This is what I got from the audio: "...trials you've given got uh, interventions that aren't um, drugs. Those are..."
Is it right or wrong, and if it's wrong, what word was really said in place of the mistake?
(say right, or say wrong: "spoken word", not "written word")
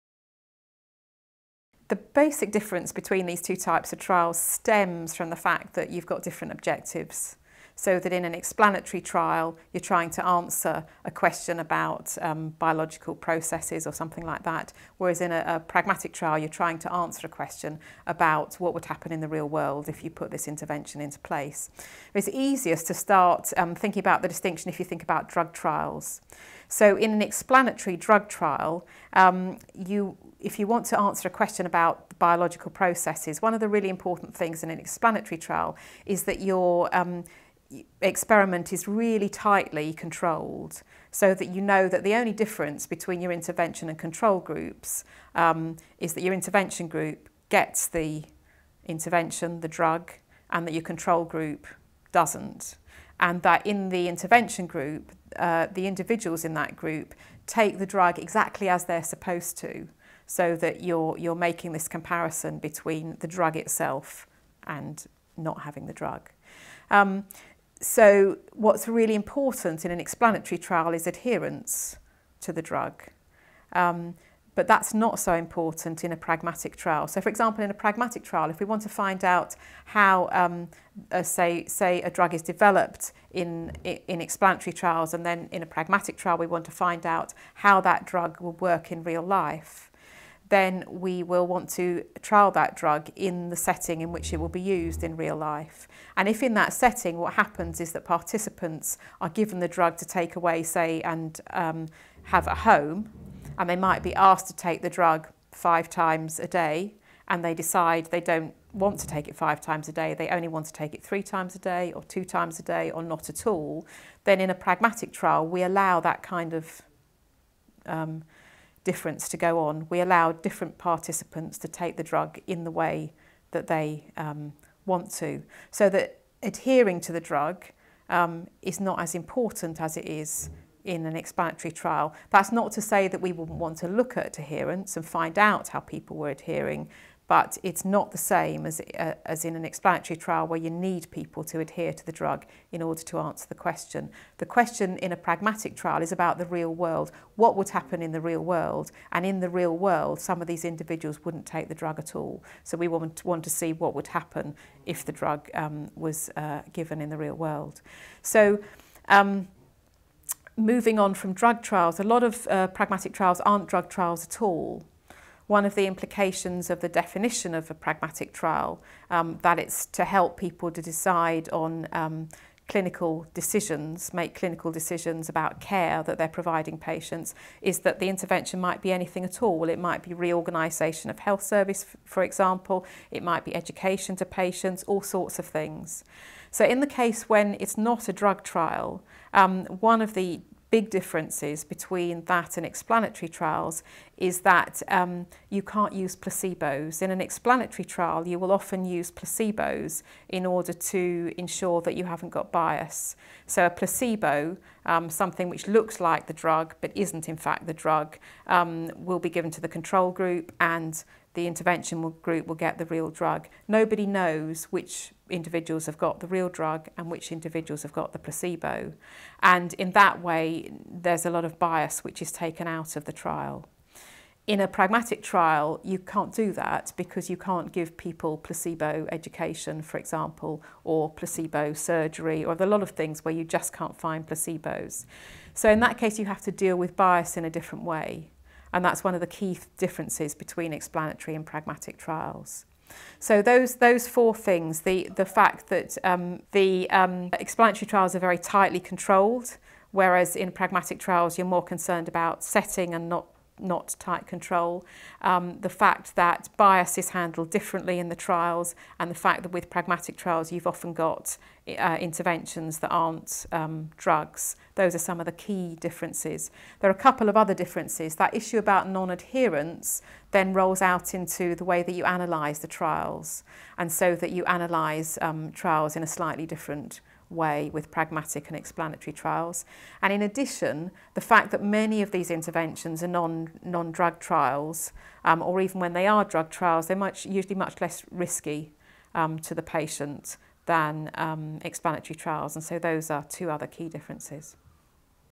wrong: "often", not "given".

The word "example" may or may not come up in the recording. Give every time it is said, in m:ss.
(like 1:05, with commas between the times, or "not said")
1:17, 3:02, 3:49.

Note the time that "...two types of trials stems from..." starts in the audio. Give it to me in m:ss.
0:03.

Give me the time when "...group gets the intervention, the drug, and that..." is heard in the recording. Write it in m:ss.
0:46.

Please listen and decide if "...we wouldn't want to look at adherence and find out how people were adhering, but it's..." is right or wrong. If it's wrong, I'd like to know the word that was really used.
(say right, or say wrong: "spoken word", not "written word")
right.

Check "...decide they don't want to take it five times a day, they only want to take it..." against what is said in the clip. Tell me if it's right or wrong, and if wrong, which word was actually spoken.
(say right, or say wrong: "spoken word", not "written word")
right.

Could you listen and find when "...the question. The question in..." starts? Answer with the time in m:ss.
2:23.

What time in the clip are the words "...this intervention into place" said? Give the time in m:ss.
0:20.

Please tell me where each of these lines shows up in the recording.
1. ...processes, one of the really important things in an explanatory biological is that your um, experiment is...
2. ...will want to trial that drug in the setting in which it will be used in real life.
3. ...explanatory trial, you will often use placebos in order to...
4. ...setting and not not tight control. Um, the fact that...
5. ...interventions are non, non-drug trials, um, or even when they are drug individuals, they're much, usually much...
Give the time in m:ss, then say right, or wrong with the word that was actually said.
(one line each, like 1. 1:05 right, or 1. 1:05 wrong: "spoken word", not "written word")
1. 0:32 wrong: "trial", not "biological"
2. 1:31 right
3. 3:17 right
4. 4:12 right
5. 4:42 wrong: "trials", not "individuals".